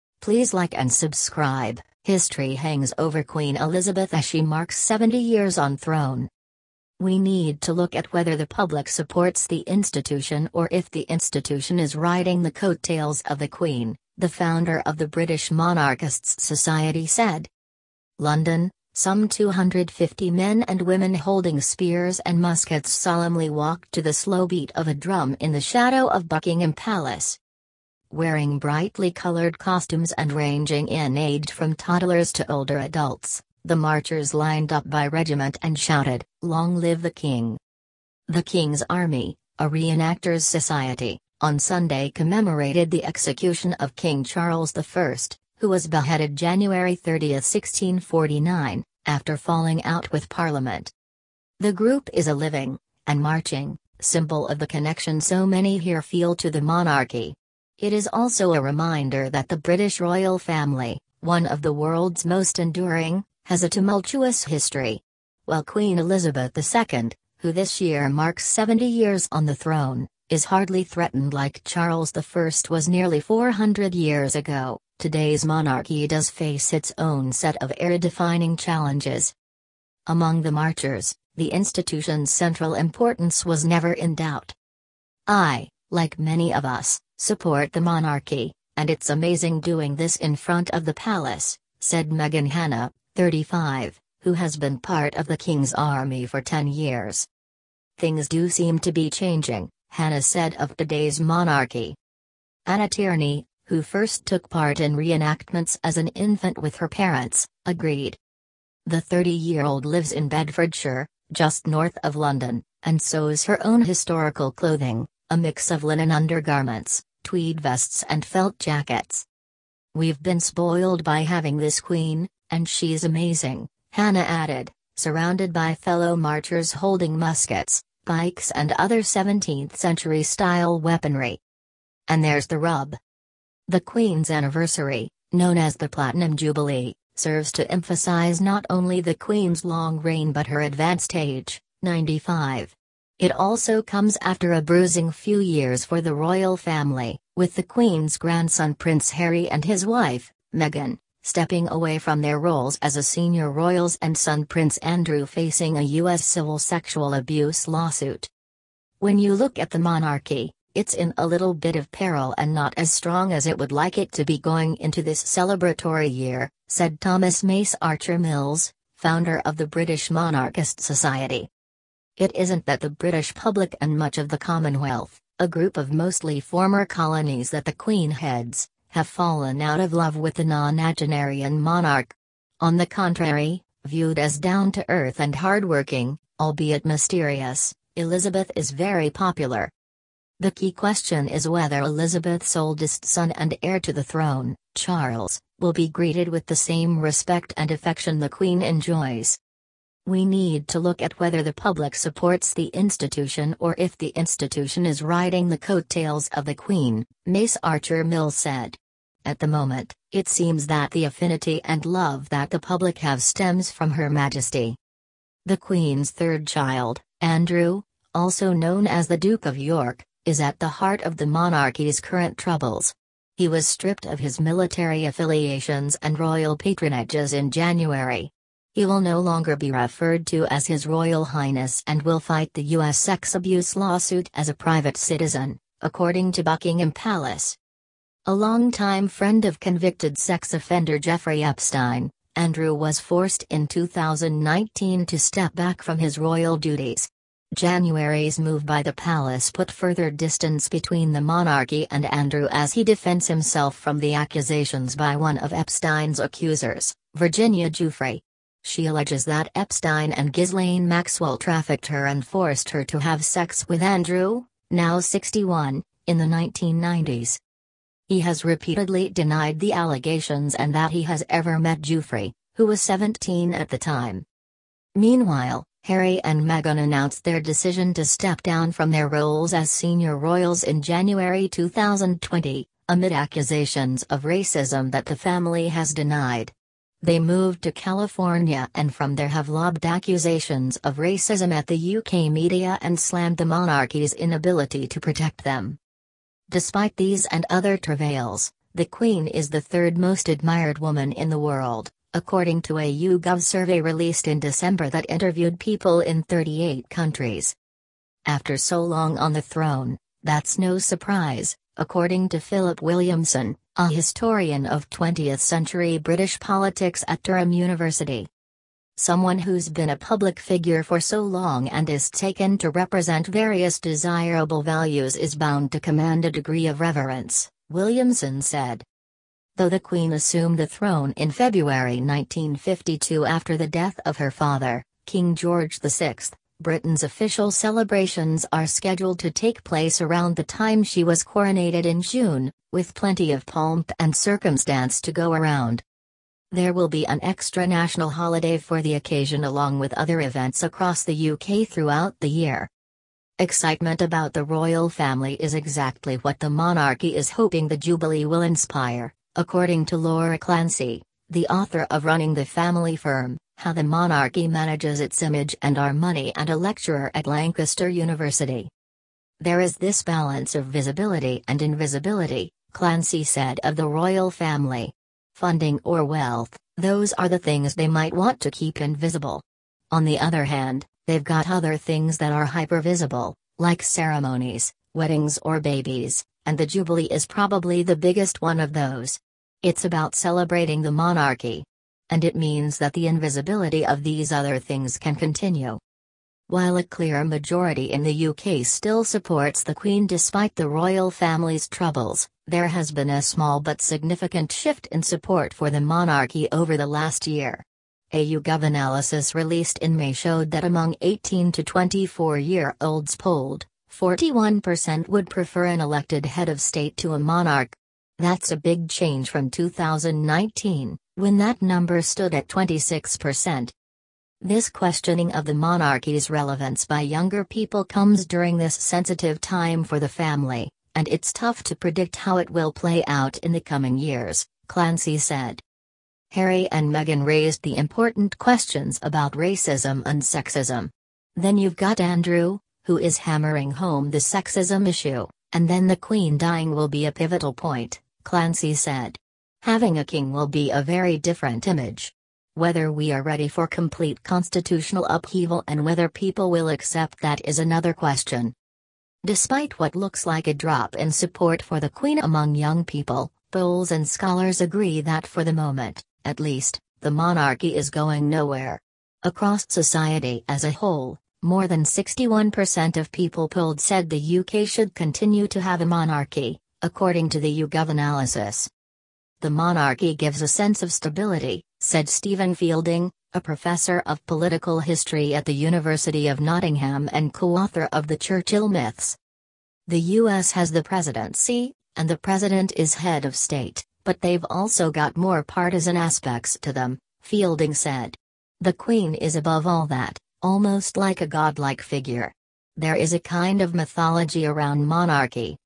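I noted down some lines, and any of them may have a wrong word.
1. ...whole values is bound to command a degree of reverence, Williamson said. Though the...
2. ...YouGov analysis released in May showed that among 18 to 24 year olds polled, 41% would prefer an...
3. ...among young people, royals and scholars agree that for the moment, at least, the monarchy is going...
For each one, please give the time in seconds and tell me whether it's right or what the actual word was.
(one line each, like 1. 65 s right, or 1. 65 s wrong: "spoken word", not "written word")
1. 323 s wrong: "desirable", not "whole"
2. 408 s right
3. 462 s wrong: "polls", not "royals".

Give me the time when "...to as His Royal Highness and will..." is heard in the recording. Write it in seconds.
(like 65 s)
230 s.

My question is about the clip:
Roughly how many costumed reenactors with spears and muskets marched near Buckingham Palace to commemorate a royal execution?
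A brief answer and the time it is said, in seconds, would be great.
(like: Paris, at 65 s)
250, at 19 s.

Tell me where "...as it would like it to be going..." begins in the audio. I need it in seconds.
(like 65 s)
163 s.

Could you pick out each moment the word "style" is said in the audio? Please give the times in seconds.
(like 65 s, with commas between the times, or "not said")
130 s.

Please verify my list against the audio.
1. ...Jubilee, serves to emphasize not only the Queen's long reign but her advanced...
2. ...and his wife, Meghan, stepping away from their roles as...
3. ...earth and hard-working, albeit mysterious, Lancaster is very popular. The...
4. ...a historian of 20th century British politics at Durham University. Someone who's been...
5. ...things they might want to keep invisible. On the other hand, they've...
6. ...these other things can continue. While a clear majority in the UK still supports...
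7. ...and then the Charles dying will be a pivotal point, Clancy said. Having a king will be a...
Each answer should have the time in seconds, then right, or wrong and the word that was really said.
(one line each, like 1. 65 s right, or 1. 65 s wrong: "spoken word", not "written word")
1. 136 s right
2. 149 s right
3. 184 s wrong: "Elizabeth", not "Lancaster"
4. 313 s right
5. 377 s right
6. 394 s right
7. 445 s wrong: "Queen", not "Charles".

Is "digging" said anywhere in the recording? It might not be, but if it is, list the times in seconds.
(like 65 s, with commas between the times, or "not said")
not said.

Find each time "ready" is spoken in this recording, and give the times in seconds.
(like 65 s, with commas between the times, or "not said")
453 s.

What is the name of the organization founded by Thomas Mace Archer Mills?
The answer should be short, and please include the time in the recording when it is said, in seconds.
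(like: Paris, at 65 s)
British Monarchist Society, at 169 s.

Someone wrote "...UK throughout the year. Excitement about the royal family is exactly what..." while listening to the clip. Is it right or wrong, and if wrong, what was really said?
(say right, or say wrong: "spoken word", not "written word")
right.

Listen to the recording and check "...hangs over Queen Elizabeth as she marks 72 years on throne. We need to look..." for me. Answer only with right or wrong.
wrong.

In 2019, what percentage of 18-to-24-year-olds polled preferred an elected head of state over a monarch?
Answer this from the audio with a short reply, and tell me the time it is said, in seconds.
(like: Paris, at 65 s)
26%, at 422 s.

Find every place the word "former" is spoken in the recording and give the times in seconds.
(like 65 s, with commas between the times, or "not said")
176 s.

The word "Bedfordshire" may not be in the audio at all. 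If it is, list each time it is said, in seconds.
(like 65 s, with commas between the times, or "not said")
110 s.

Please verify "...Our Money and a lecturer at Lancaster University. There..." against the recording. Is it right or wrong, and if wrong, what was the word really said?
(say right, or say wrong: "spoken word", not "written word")
right.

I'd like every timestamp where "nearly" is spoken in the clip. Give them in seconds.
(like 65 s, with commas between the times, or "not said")
72 s.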